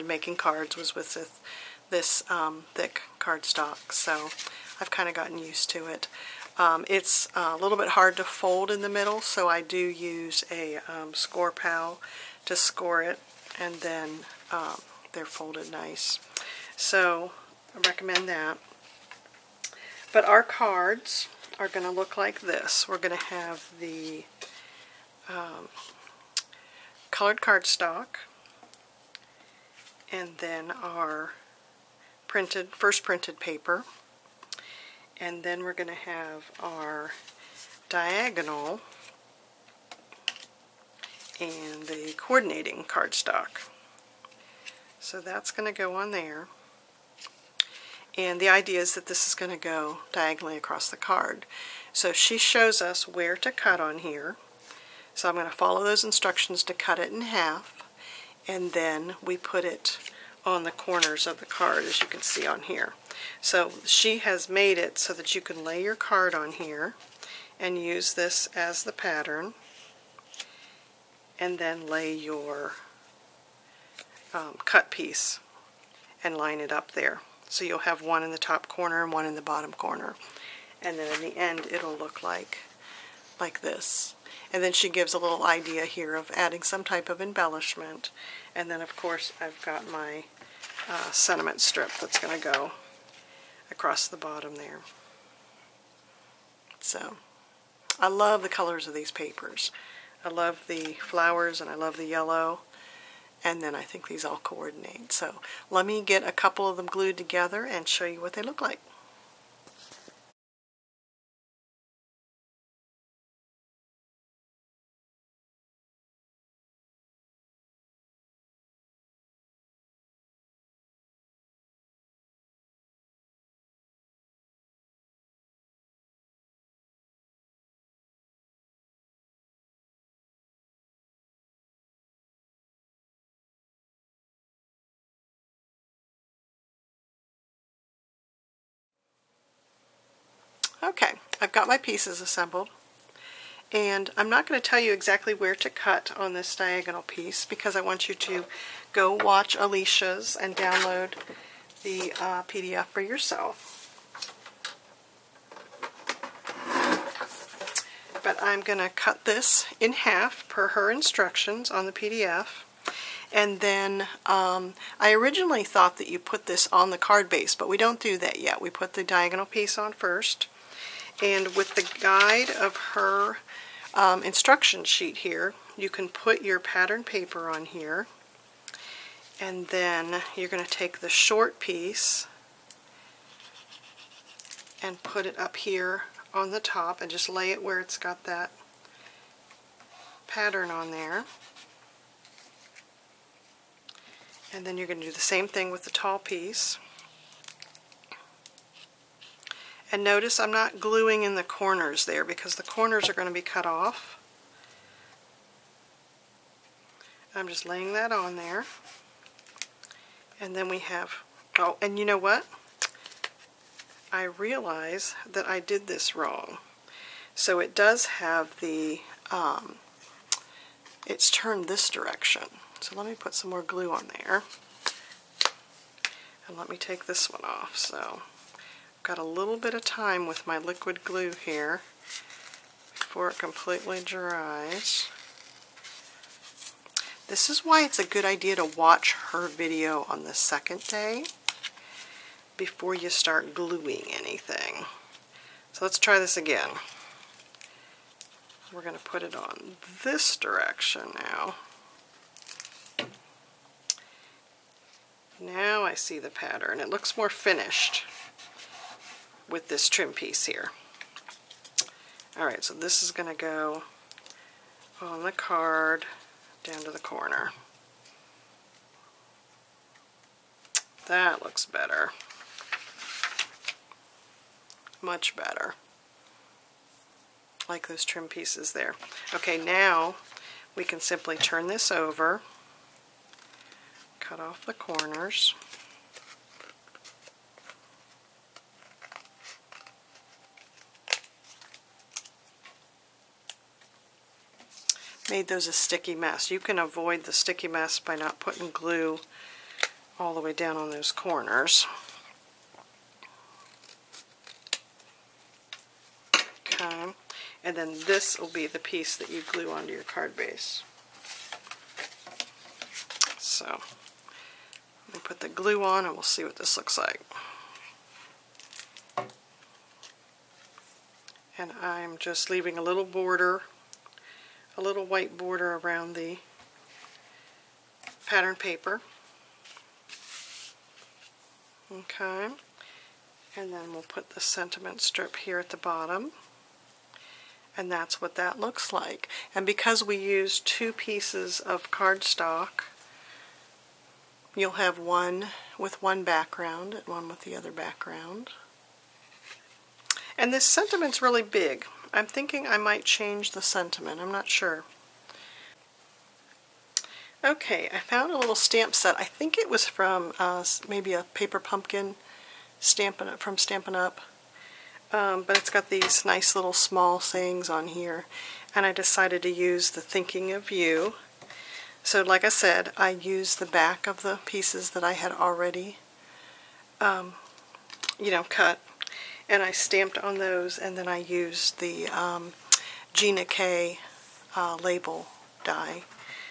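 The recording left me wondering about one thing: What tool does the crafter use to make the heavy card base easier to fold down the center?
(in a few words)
Score Pal.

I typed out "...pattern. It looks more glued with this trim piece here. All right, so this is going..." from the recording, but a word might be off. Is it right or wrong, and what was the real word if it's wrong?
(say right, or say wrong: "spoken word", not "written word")
wrong: "finished", not "glued".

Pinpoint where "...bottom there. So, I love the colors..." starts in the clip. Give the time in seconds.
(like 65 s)
94 s.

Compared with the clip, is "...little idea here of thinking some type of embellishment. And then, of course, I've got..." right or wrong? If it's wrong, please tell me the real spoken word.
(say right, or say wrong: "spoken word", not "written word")
wrong: "adding", not "thinking".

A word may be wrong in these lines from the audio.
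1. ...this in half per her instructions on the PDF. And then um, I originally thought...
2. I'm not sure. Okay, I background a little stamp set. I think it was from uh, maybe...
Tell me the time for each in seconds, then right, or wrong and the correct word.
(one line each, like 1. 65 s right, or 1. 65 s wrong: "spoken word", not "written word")
1. 159 s right
2. 354 s wrong: "found", not "background".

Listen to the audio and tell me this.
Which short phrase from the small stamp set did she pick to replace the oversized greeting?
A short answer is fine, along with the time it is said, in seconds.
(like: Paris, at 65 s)
Thinking of You, at 370 s.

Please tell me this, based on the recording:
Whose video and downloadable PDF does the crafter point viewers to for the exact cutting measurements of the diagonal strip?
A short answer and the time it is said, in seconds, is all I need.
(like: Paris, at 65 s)
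Alicia, at 149 s.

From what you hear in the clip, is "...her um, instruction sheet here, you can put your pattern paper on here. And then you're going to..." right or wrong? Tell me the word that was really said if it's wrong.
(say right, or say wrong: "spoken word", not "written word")
right.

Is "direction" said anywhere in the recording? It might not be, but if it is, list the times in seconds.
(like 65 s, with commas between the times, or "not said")
221 s, 250 s.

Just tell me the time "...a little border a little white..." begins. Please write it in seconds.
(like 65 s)
322 s.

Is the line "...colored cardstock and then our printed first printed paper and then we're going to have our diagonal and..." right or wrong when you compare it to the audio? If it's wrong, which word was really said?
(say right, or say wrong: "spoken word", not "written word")
right.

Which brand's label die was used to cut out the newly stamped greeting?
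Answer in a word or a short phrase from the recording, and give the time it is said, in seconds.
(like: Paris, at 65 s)
Gina K, at 383 s.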